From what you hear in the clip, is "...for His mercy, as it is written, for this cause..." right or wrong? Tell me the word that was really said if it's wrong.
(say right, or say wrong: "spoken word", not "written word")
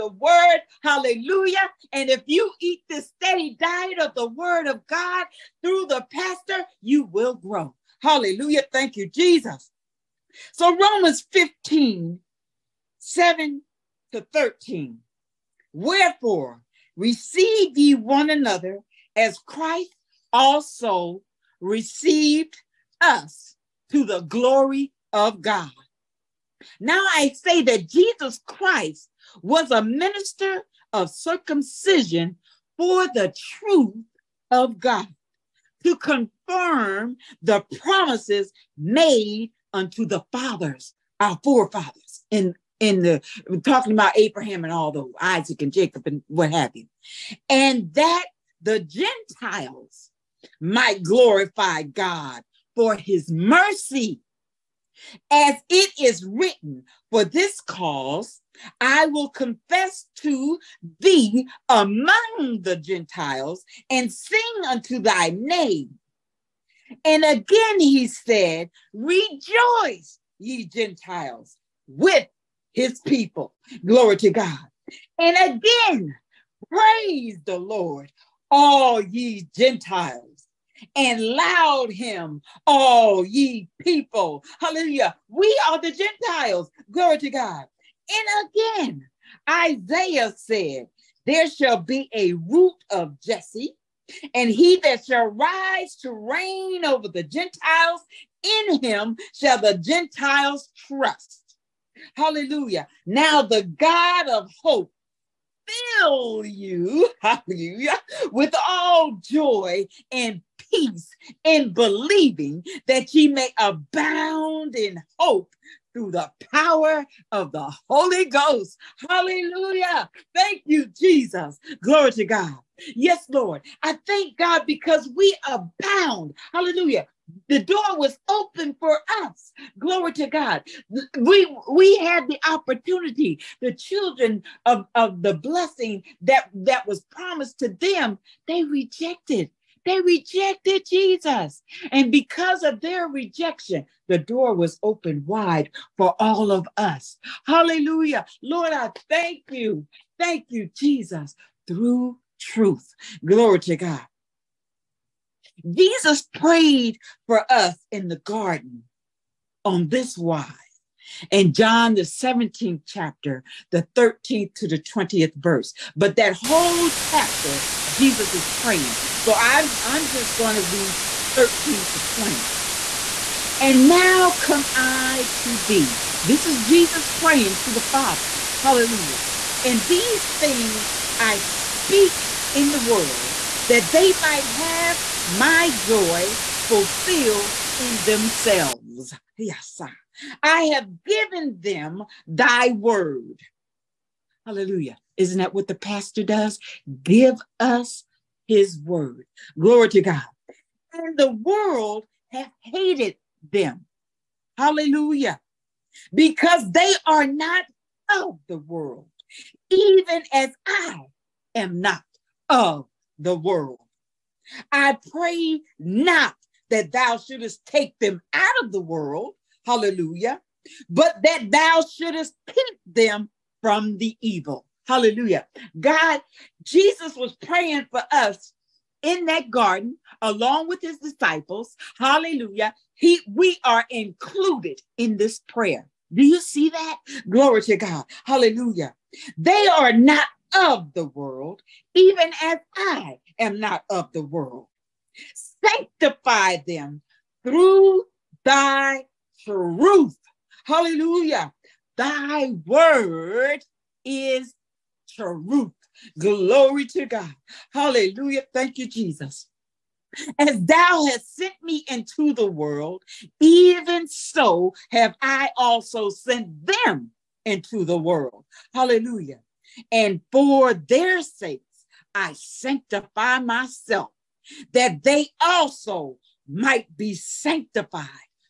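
right.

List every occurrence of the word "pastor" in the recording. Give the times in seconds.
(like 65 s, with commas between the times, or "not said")
6 s, 195 s.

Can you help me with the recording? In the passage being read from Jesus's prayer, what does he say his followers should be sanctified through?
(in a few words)
thy truth.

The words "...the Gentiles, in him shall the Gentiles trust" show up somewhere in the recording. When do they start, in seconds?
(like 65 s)
97 s.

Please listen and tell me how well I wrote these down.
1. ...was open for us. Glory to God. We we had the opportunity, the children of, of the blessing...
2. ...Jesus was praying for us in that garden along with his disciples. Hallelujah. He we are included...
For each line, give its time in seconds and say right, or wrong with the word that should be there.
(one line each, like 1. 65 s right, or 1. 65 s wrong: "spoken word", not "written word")
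1. 127 s right
2. 226 s right.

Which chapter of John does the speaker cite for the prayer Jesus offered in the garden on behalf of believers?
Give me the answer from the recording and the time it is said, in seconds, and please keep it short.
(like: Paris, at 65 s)
17th chapter, at 161 s.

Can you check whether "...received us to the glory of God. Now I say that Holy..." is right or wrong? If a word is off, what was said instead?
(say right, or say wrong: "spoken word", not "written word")
wrong: "Jesus", not "Holy".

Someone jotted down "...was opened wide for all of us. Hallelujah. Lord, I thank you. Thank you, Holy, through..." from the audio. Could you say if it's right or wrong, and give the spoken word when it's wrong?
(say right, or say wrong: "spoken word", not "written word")
wrong: "Jesus", not "Holy".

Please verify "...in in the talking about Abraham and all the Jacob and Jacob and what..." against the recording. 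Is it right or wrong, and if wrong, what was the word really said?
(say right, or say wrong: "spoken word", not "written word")
wrong: "Isaac", not "Jacob".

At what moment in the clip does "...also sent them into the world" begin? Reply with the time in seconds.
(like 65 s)
265 s.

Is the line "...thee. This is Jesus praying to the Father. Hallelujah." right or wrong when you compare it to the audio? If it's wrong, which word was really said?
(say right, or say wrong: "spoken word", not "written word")
right.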